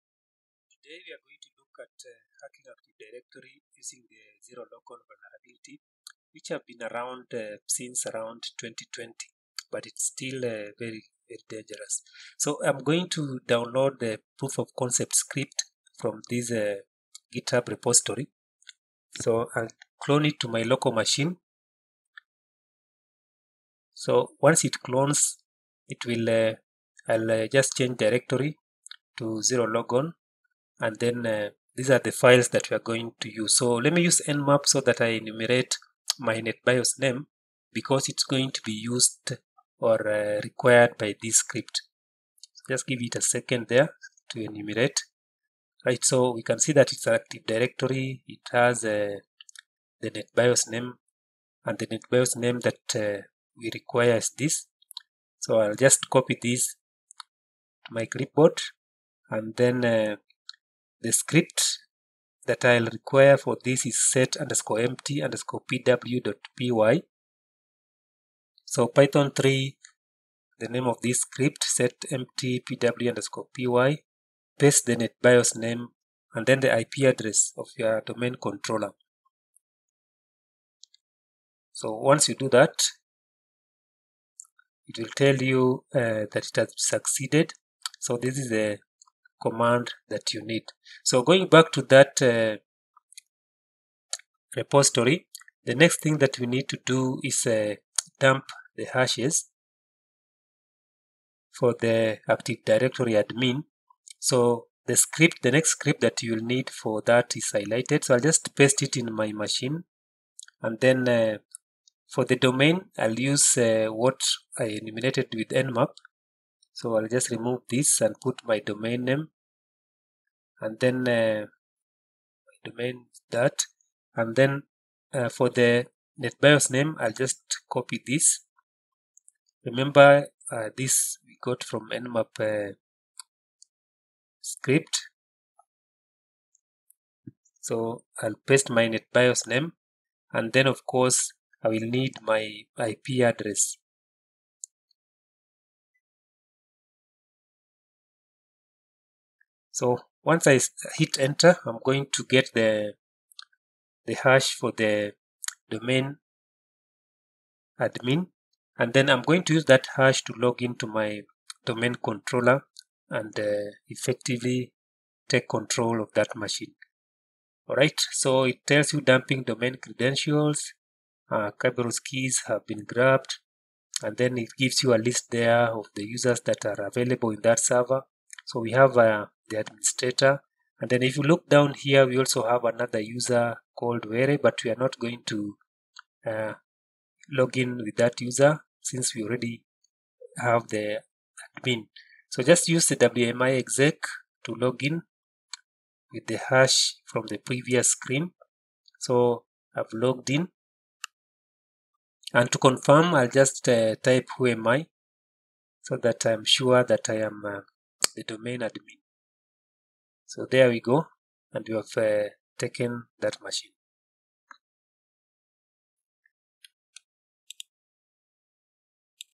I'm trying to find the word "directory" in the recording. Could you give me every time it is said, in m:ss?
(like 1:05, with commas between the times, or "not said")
0:03, 0:27, 0:47, 1:42.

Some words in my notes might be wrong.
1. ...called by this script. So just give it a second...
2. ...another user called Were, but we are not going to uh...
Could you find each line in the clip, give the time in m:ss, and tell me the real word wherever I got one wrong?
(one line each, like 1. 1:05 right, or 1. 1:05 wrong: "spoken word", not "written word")
1. 0:40 wrong: "required", not "called"
2. 3:02 right.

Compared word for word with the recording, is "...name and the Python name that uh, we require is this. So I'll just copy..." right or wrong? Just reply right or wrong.
wrong.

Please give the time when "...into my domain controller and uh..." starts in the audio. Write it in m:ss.
2:40.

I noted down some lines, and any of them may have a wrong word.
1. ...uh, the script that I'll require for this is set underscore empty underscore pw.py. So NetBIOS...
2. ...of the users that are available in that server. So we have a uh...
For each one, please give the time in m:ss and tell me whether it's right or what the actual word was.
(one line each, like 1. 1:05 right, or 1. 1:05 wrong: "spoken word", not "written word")
1. 0:59 wrong: "Python", not "NetBIOS"
2. 2:55 right.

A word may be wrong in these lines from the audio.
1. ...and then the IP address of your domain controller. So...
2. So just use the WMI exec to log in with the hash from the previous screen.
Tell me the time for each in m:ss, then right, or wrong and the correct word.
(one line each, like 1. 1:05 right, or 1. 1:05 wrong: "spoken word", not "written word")
1. 1:16 right
2. 3:12 right.